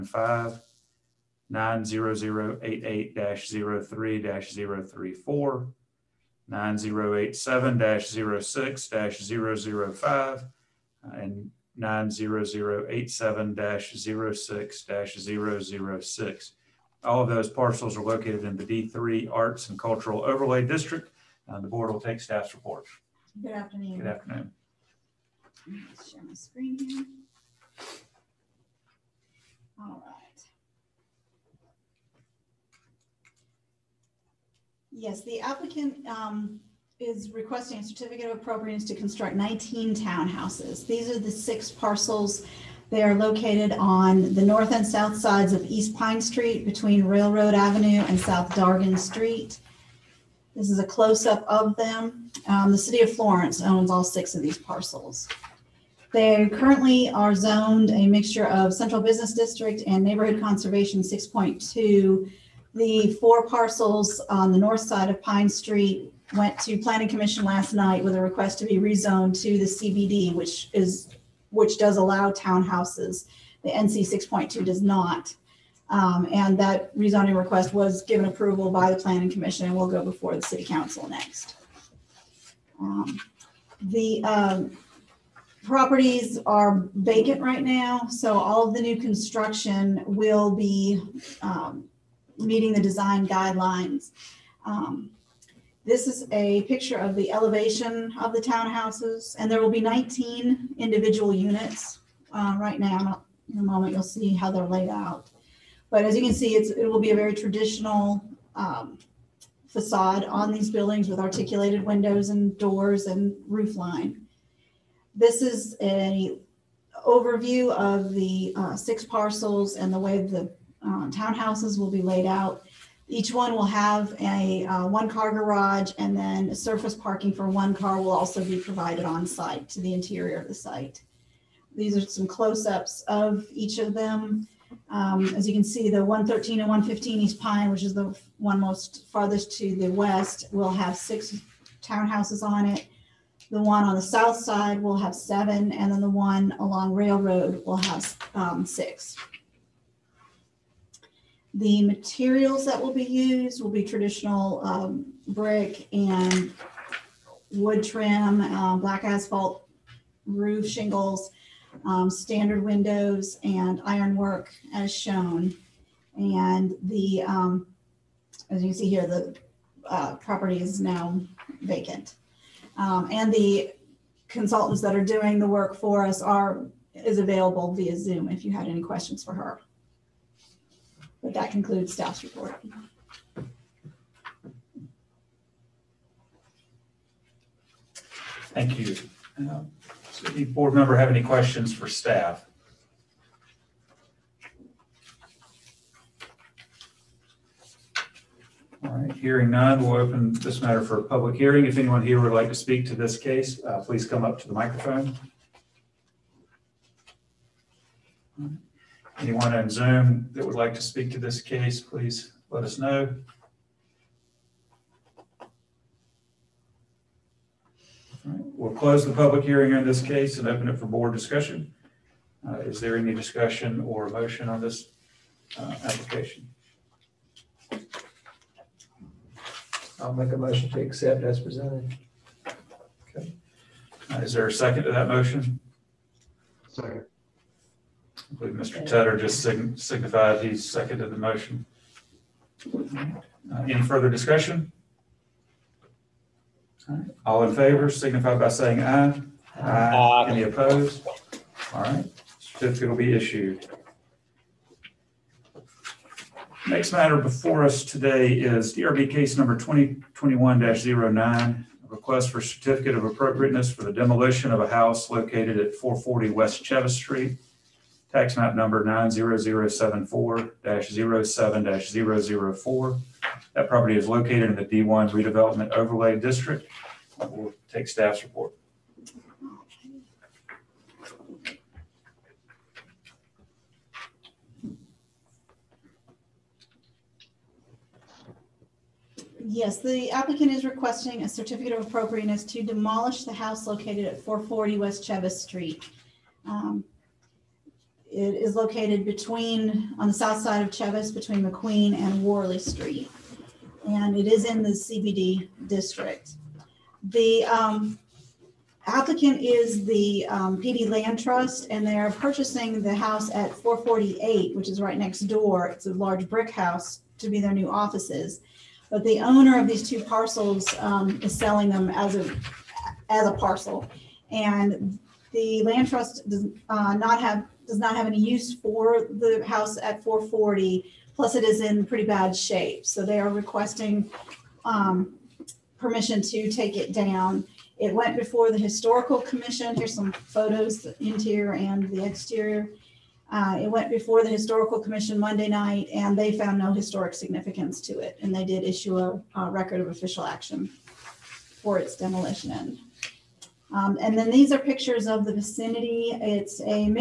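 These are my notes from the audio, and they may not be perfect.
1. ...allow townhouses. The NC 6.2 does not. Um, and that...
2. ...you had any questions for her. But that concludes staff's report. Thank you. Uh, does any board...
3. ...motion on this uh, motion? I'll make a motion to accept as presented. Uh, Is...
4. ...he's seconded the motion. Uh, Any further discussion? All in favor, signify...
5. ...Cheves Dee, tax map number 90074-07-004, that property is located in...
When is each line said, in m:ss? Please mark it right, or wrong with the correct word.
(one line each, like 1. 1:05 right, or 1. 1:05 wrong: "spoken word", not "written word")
1. 1:11 right
2. 2:58 right
3. 3:44 wrong: "application", not "motion"
4. 4:00 right
5. 4:26 wrong: "Street", not "Dee".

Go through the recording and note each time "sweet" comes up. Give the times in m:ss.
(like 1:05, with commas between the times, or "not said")
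not said.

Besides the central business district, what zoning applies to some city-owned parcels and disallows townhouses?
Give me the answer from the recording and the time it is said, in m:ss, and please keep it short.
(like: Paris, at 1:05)
neighborhood conservation 6.2, at 1:00.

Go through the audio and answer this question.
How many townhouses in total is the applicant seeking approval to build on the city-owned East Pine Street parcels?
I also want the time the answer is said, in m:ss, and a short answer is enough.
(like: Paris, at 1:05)
19, at 0:39.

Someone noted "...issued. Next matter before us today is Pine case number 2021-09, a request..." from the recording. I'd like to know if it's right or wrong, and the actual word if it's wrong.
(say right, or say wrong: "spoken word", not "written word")
wrong: "DRB", not "Pine".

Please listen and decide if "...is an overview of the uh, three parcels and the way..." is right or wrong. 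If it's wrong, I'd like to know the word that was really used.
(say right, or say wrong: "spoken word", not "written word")
wrong: "six", not "three".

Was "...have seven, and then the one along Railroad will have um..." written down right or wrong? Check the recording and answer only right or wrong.
right.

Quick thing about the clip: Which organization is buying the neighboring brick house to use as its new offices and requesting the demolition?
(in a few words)
Pee Dee Land Trust.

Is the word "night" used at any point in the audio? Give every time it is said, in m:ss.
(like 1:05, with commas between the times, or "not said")
1:07, 5:45.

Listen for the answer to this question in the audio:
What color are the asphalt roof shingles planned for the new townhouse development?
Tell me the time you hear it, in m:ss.
2:38.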